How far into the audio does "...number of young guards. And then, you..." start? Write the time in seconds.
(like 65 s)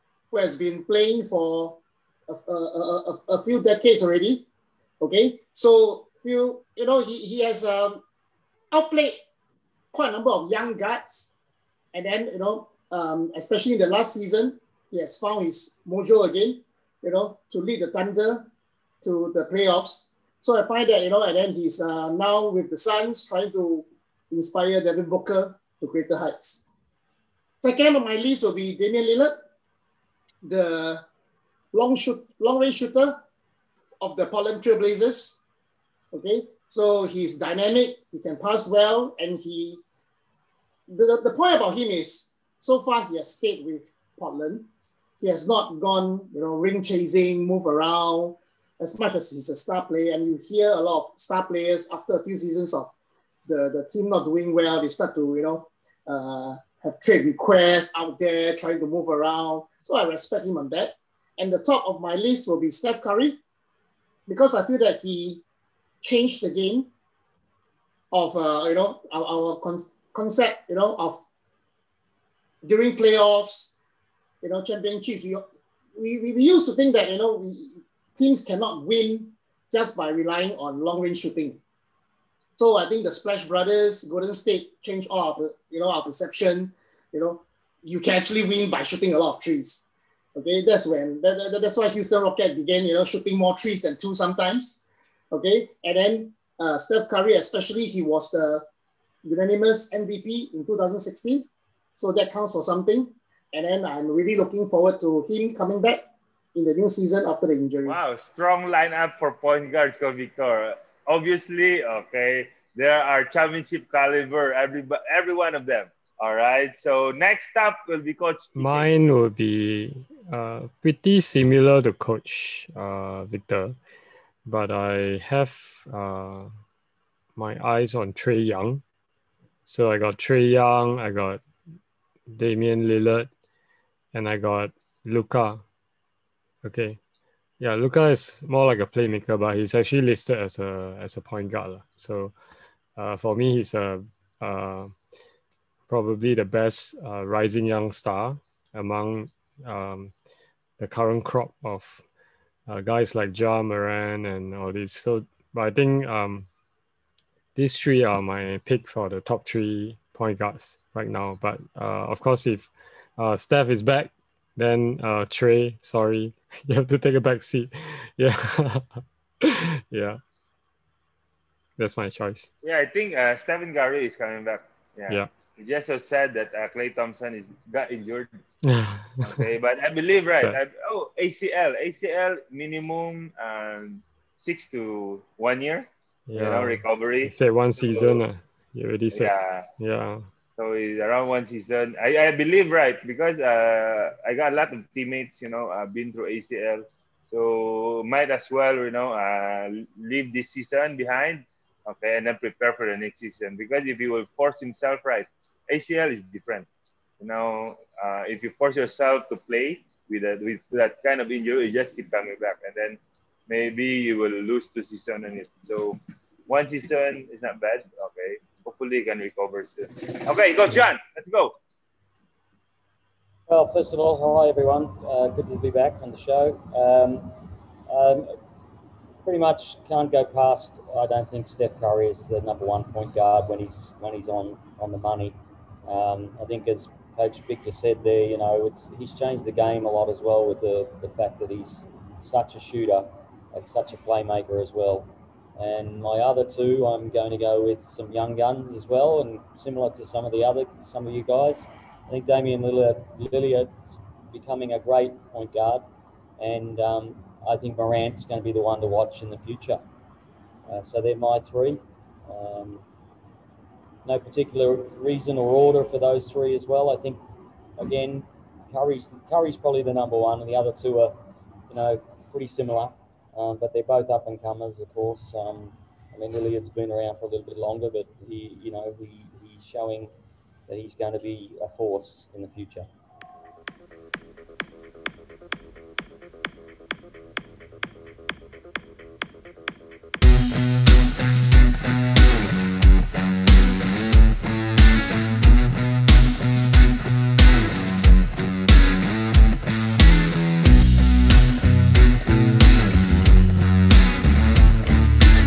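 10 s.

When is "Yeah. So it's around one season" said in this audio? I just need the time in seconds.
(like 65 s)
189 s.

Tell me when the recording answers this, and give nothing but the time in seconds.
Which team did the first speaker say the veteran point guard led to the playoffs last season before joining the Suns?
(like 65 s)
17 s.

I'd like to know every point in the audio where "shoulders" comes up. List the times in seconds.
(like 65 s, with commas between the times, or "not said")
not said.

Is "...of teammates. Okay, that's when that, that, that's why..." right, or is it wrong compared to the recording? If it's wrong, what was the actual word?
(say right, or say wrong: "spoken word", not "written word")
wrong: "trees", not "teammates".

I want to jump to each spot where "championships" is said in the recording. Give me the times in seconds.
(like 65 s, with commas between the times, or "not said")
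74 s, 113 s.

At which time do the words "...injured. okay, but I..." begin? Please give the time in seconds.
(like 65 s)
177 s.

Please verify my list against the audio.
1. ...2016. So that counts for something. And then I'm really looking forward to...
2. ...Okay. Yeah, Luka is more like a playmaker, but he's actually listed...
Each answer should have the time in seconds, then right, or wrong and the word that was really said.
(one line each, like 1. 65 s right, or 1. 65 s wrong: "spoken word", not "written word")
1. 100 s right
2. 136 s right.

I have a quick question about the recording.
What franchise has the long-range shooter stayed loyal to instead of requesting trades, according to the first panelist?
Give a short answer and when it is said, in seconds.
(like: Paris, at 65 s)
Portland Trail Blazers, at 34 s.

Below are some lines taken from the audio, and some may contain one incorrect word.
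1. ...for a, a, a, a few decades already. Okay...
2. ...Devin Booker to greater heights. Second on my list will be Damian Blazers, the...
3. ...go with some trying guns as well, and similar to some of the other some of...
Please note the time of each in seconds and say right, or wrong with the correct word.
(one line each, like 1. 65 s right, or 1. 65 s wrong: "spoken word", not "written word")
1. 1 s right
2. 24 s wrong: "Lillard", not "Blazers"
3. 247 s wrong: "young", not "trying".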